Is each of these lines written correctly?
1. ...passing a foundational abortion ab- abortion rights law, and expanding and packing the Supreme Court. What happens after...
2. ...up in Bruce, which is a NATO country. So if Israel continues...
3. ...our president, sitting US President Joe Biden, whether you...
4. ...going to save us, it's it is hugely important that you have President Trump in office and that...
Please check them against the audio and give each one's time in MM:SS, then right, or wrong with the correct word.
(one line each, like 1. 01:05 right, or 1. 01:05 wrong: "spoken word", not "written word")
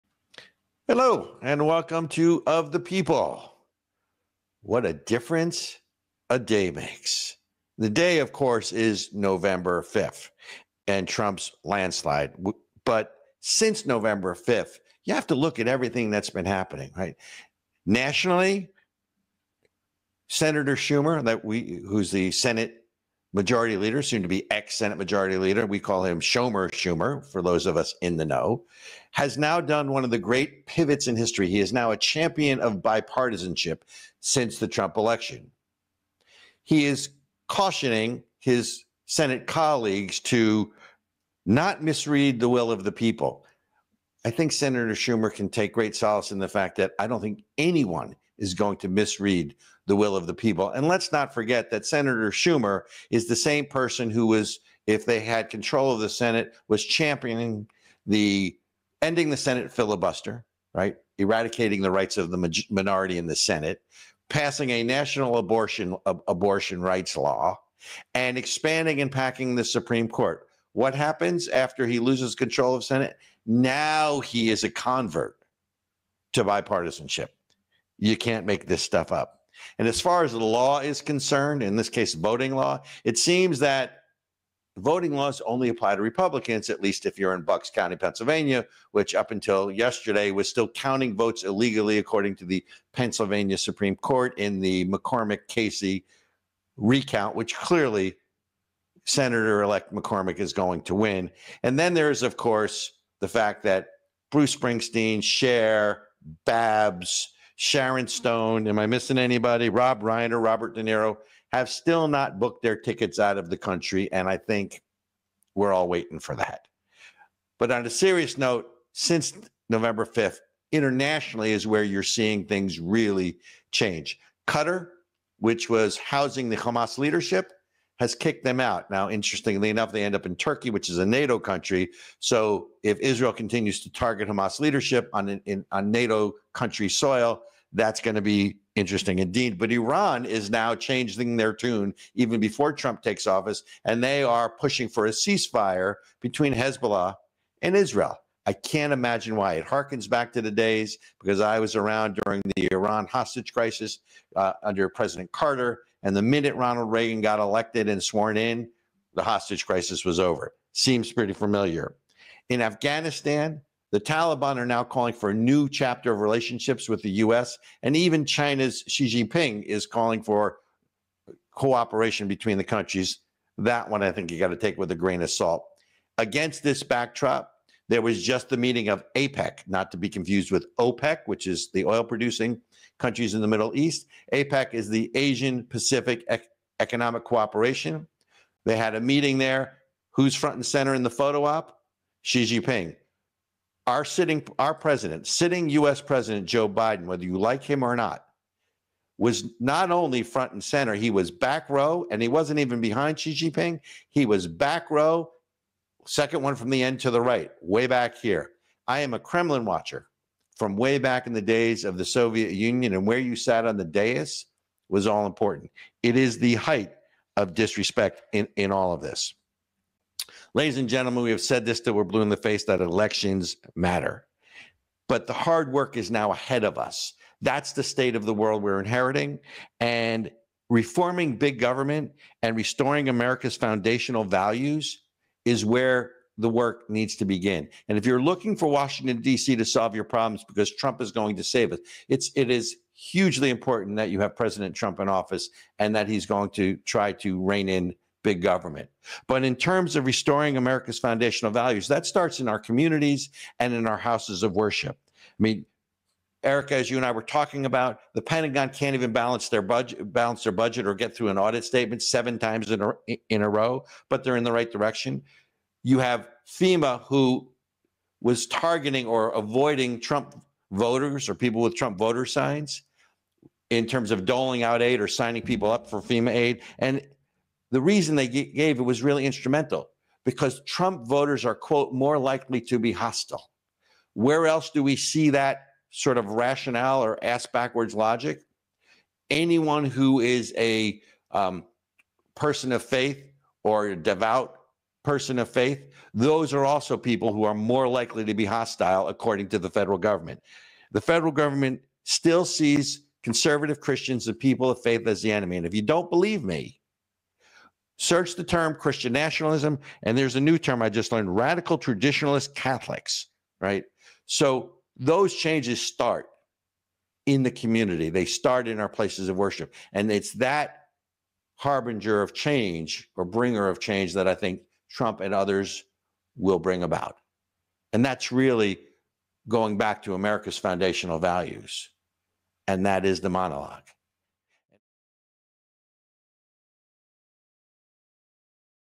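1. 01:04 wrong: "national", not "foundational"
2. 02:10 wrong: "Turkey", not "Bruce"
3. 03:14 right
4. 04:01 right.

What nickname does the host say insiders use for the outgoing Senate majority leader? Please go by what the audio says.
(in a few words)
Shomer Schumer.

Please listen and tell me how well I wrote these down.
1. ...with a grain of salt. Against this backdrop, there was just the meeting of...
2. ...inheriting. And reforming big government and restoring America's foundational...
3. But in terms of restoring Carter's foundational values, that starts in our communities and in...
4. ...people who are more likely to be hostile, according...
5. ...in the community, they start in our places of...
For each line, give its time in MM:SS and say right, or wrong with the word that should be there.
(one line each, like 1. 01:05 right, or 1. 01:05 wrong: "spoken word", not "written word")
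1. 02:54 right
2. 03:48 right
3. 04:09 wrong: "America", not "Carter"
4. 04:56 right
5. 05:17 right.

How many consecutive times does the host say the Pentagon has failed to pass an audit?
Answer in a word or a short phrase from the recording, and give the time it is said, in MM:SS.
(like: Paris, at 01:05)
7, at 04:22.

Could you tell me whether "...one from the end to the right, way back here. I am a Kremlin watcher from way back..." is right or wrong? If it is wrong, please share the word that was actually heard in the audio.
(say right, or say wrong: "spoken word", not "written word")
right.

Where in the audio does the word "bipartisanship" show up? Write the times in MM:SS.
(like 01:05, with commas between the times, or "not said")
00:32, 01:16.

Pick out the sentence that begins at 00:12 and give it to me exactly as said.
But since November 5th, you have to look at everything that's been happening, right?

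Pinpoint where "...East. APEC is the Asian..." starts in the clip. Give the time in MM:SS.
03:03.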